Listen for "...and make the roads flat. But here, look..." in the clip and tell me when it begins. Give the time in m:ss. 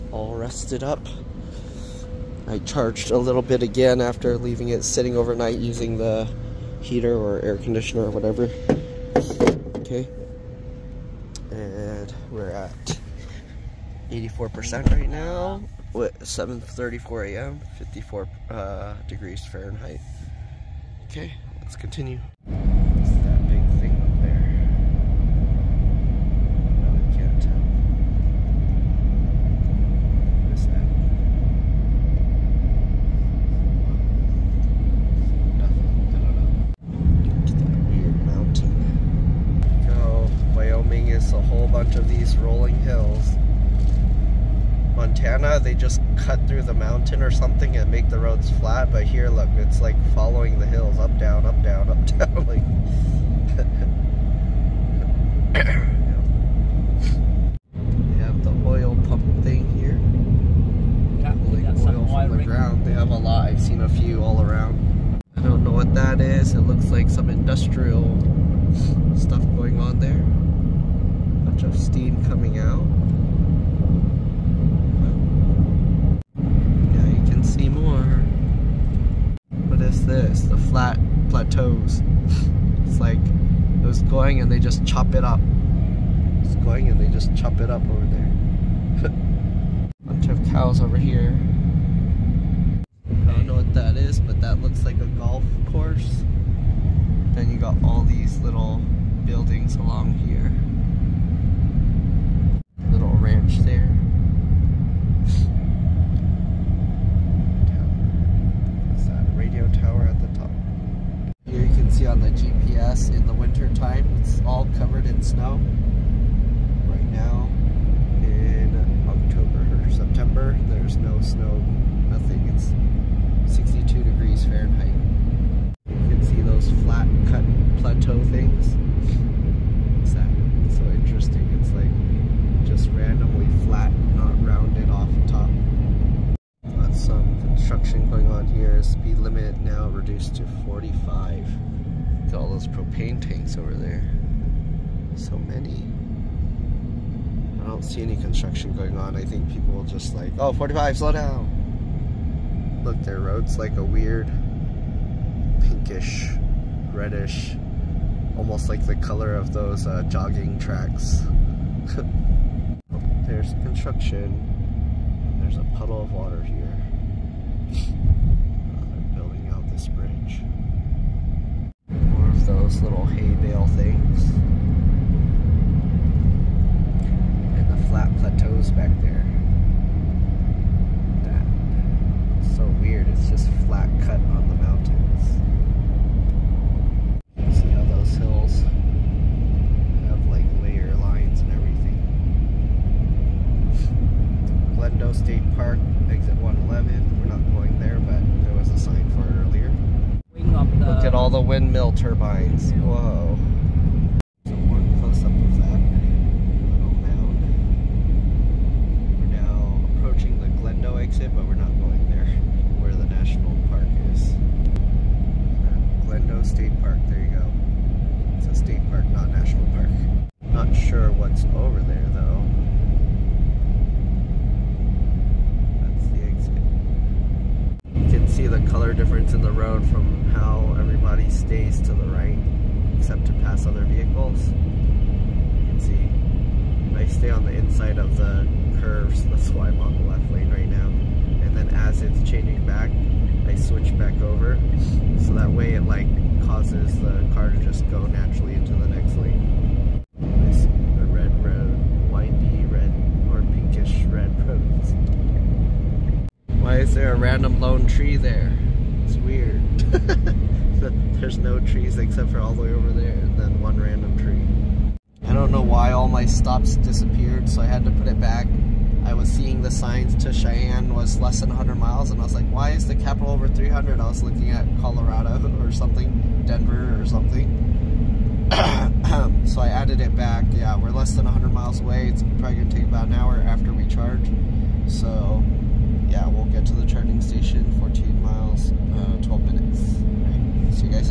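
0:47.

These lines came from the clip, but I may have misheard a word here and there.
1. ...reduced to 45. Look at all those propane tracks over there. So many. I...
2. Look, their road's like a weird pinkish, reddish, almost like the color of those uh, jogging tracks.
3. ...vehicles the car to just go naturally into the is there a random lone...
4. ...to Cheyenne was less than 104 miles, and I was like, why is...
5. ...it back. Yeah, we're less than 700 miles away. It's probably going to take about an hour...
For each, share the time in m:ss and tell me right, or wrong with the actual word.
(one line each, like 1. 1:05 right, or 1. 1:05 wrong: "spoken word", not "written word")
1. 2:19 wrong: "tanks", not "tracks"
2. 2:32 right
3. 4:06 wrong: "causes", not "vehicles"
4. 4:30 wrong: "100", not "104"
5. 4:39 wrong: "100", not "700".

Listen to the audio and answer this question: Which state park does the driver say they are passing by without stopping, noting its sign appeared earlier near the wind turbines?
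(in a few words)
Glendo State Park.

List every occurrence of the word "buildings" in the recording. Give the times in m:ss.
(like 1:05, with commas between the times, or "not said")
1:39, 2:49.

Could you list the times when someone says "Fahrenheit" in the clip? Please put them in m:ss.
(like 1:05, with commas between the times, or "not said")
0:19, 2:04.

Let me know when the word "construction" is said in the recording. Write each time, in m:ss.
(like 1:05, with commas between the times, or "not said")
2:17, 2:28, 2:43.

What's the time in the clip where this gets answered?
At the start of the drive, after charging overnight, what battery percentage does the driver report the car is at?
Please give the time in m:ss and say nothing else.
0:14.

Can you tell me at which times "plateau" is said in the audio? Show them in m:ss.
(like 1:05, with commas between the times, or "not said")
2:07, 2:58.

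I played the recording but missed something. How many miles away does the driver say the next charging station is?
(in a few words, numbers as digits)
14 miles.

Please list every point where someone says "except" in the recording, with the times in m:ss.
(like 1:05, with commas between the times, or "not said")
3:52, 4:21.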